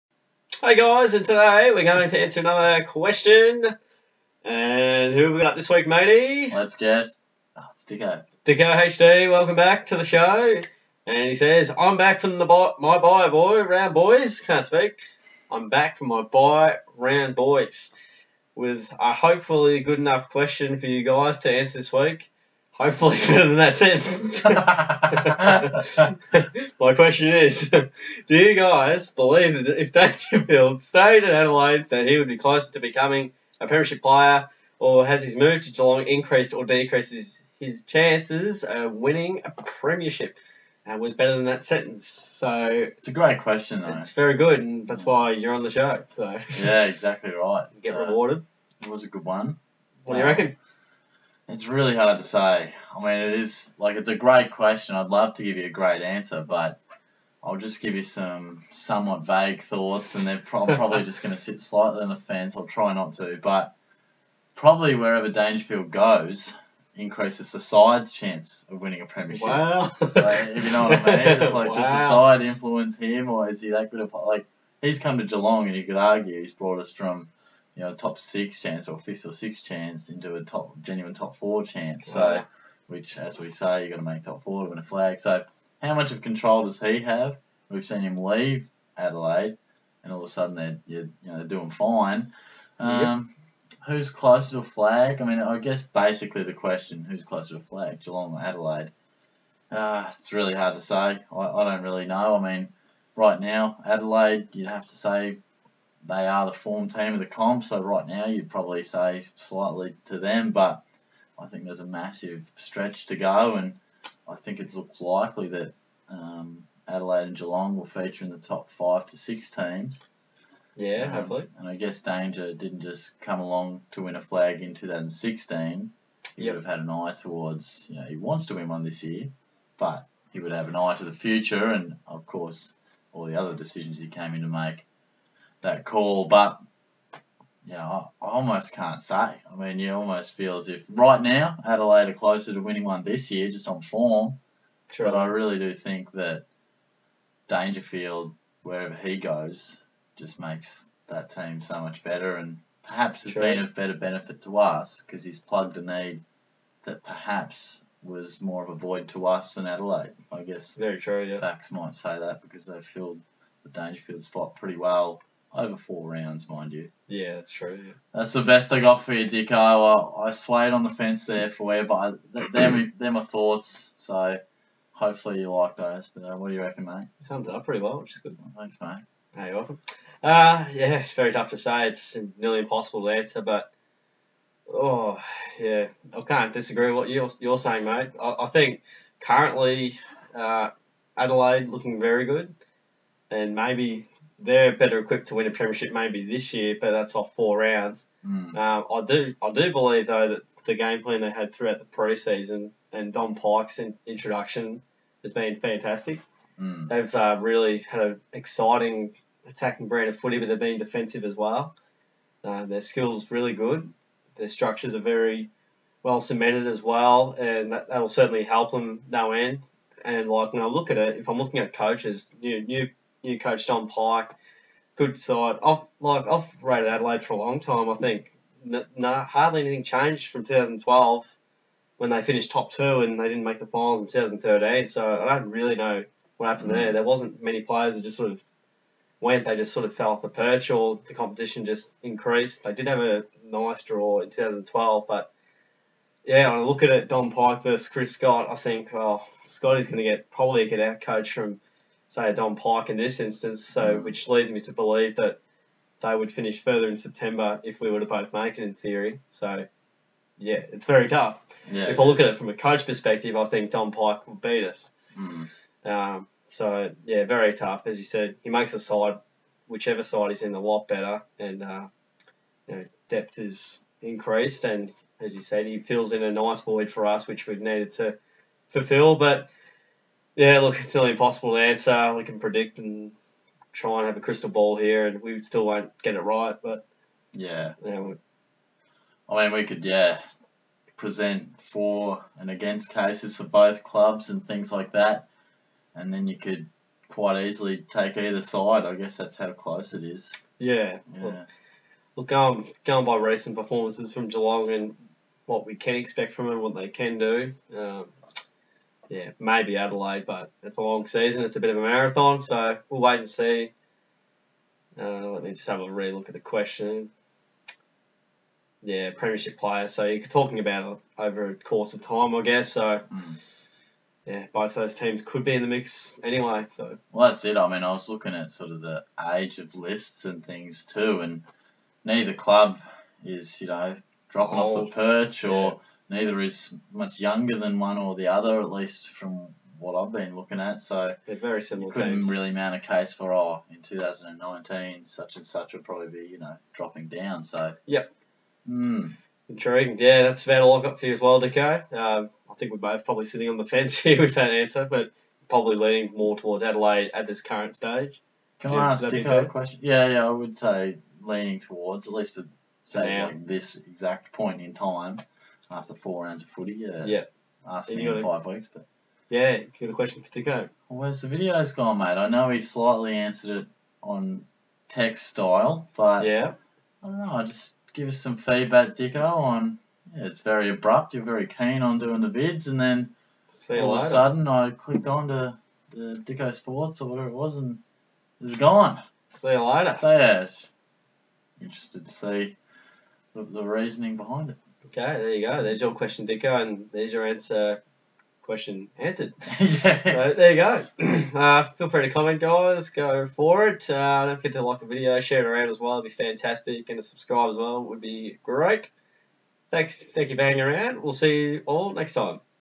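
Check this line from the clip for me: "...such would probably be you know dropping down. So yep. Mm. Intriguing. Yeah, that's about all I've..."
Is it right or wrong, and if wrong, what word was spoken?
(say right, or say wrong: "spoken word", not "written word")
right.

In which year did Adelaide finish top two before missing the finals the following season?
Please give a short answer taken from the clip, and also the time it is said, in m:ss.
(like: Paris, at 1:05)
2012, at 3:50.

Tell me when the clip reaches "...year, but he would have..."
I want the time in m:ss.
2:09.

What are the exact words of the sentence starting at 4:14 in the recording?
which leads me to believe that they would finish further in September if we were to both make it in theory.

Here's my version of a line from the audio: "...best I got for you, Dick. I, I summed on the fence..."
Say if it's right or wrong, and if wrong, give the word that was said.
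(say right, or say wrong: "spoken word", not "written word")
wrong: "swayed", not "summed".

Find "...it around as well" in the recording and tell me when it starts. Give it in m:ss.
6:45.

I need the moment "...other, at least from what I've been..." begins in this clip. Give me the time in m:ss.
5:38.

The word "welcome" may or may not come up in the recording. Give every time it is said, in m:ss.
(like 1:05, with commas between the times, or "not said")
0:09, 2:59.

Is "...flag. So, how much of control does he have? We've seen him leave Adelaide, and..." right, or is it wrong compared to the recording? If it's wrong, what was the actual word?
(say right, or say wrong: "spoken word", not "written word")
right.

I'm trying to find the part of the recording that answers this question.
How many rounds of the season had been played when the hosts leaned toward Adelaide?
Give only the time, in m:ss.
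6:05.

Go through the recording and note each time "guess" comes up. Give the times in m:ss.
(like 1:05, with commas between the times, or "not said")
0:06, 1:35, 2:01, 2:40, 4:58, 5:22.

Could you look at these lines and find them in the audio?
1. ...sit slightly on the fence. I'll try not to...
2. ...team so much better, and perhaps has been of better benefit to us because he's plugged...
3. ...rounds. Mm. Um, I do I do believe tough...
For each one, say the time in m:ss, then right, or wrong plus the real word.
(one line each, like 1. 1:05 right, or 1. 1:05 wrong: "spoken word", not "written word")
1. 1:01 right
2. 2:31 right
3. 3:17 wrong: "though", not "tough".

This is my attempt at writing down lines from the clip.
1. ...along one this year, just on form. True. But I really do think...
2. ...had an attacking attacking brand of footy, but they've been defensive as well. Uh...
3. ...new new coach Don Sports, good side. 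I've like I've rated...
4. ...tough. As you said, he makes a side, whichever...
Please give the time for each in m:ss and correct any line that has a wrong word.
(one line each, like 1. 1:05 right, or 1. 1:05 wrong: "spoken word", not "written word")
1. 2:22 wrong: "winning", not "along"
2. 3:27 wrong: "exciting", not "attacking"
3. 3:42 wrong: "Pyke", not "Sports"
4. 4:27 right.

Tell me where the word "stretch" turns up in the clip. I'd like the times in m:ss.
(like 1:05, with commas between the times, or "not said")
1:52.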